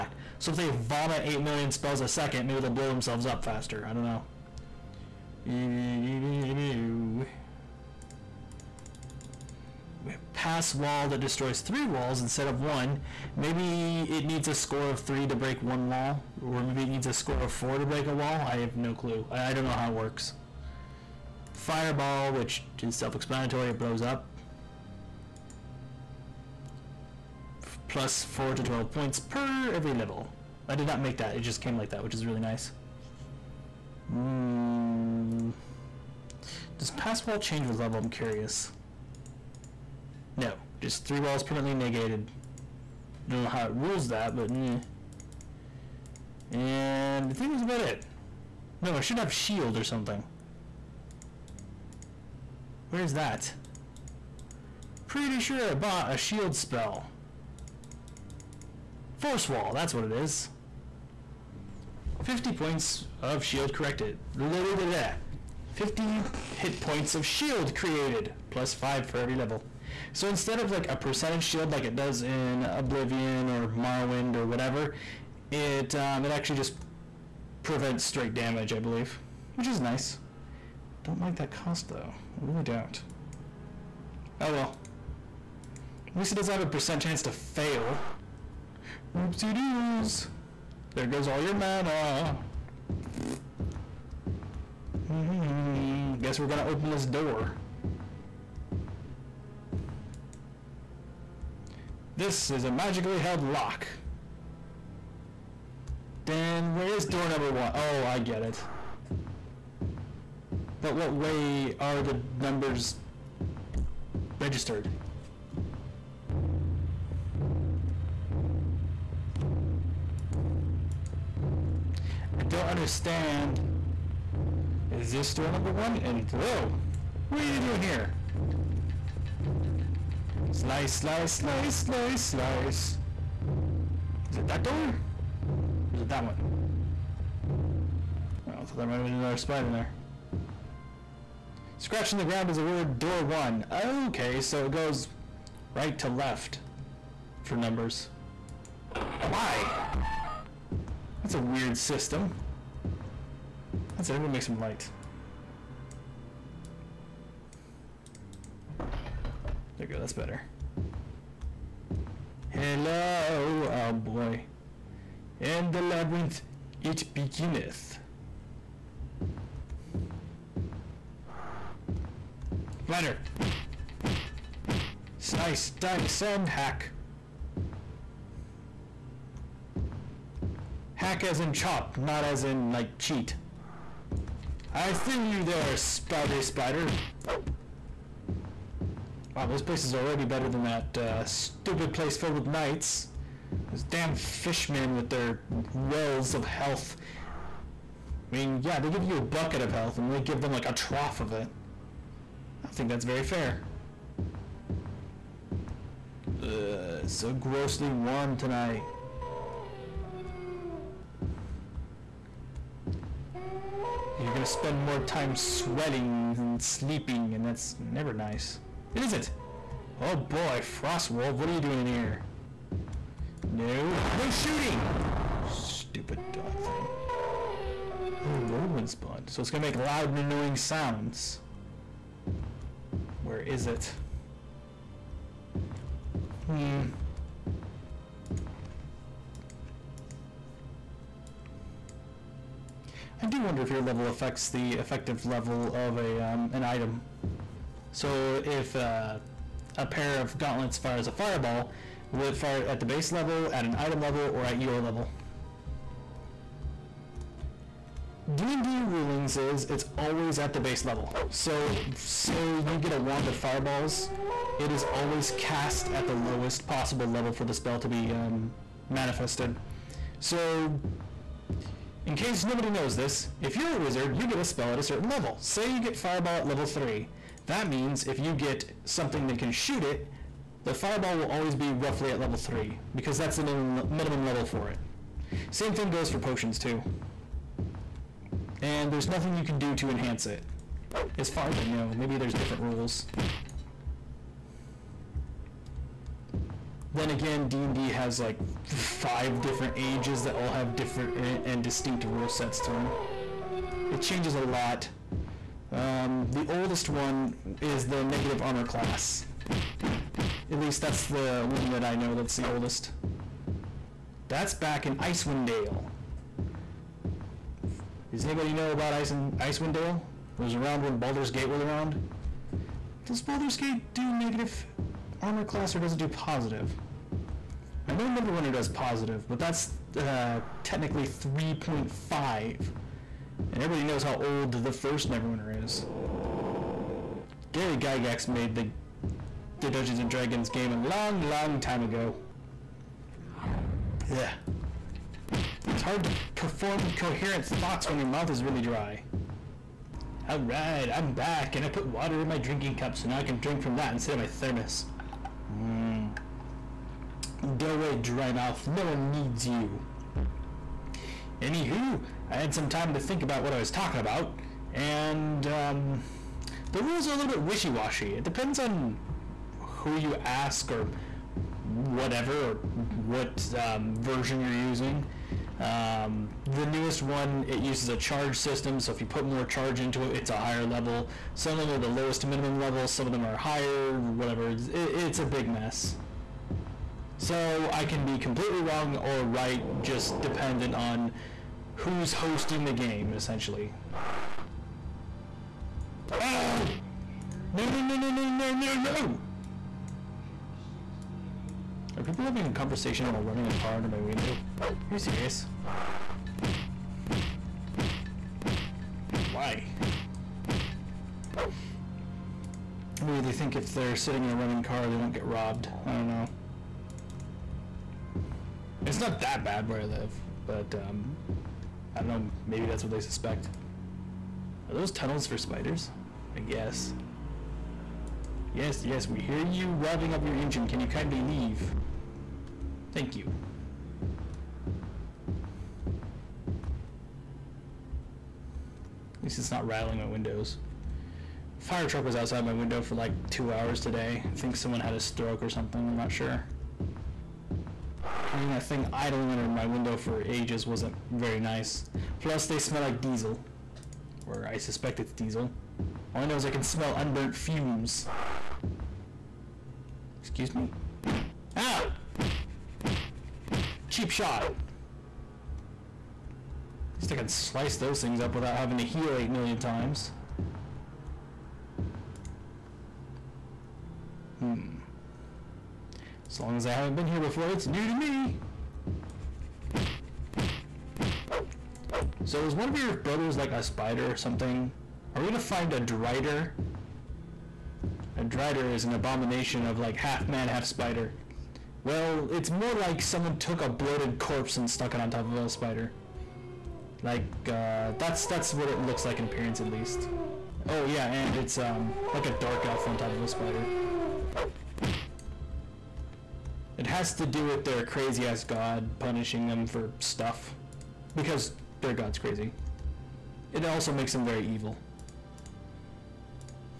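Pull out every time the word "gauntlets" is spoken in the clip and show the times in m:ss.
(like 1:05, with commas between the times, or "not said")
4:10.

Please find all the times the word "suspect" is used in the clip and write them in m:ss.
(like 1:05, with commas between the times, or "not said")
7:03, 7:34.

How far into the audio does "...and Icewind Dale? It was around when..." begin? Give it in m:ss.
5:19.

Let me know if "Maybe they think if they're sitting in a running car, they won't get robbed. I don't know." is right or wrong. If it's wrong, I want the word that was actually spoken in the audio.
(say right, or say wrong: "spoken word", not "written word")
right.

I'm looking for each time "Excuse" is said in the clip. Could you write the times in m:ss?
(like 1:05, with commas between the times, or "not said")
7:40.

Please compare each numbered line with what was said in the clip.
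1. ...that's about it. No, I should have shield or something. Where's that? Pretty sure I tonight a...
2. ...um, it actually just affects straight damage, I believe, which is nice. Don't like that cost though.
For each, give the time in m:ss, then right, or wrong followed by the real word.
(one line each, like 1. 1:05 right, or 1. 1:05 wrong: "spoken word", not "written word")
1. 0:47 wrong: "bought", not "tonight"
2. 1:15 wrong: "prevents", not "affects".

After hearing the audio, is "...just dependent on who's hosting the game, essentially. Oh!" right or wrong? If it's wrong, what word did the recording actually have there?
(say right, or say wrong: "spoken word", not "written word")
right.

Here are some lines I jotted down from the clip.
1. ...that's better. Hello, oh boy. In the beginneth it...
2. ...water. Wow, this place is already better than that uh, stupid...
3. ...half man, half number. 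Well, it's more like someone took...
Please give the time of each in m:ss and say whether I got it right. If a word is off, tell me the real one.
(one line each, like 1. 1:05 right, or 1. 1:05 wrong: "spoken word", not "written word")
1. 2:39 wrong: "labyrinth", not "beginneth"
2. 3:06 wrong: "spider", not "water"
3. 8:09 wrong: "spider", not "number".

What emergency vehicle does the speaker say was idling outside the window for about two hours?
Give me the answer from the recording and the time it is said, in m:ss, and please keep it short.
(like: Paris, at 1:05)
Fire truck, at 7:21.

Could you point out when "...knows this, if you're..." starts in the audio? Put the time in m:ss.
4:32.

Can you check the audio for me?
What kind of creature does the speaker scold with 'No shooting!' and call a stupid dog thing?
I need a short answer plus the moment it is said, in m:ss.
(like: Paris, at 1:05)
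Frostwolf, at 3:40.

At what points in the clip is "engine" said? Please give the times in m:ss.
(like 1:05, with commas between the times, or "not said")
7:10.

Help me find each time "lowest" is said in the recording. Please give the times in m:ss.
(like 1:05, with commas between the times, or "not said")
4:26, 6:21.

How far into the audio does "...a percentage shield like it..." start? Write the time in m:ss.
1:10.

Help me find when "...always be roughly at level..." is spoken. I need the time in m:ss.
4:41.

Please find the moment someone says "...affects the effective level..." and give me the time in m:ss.
4:04.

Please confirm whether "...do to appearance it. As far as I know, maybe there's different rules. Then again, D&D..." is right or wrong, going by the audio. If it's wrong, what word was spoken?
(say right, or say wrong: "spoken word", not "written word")
wrong: "enhance", not "appearance".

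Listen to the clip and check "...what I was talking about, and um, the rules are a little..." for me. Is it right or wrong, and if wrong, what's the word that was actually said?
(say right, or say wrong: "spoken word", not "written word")
right.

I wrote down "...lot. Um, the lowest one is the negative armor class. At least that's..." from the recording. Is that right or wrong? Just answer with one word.
wrong.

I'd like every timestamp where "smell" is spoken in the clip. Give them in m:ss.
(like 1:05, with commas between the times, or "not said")
7:32, 7:36.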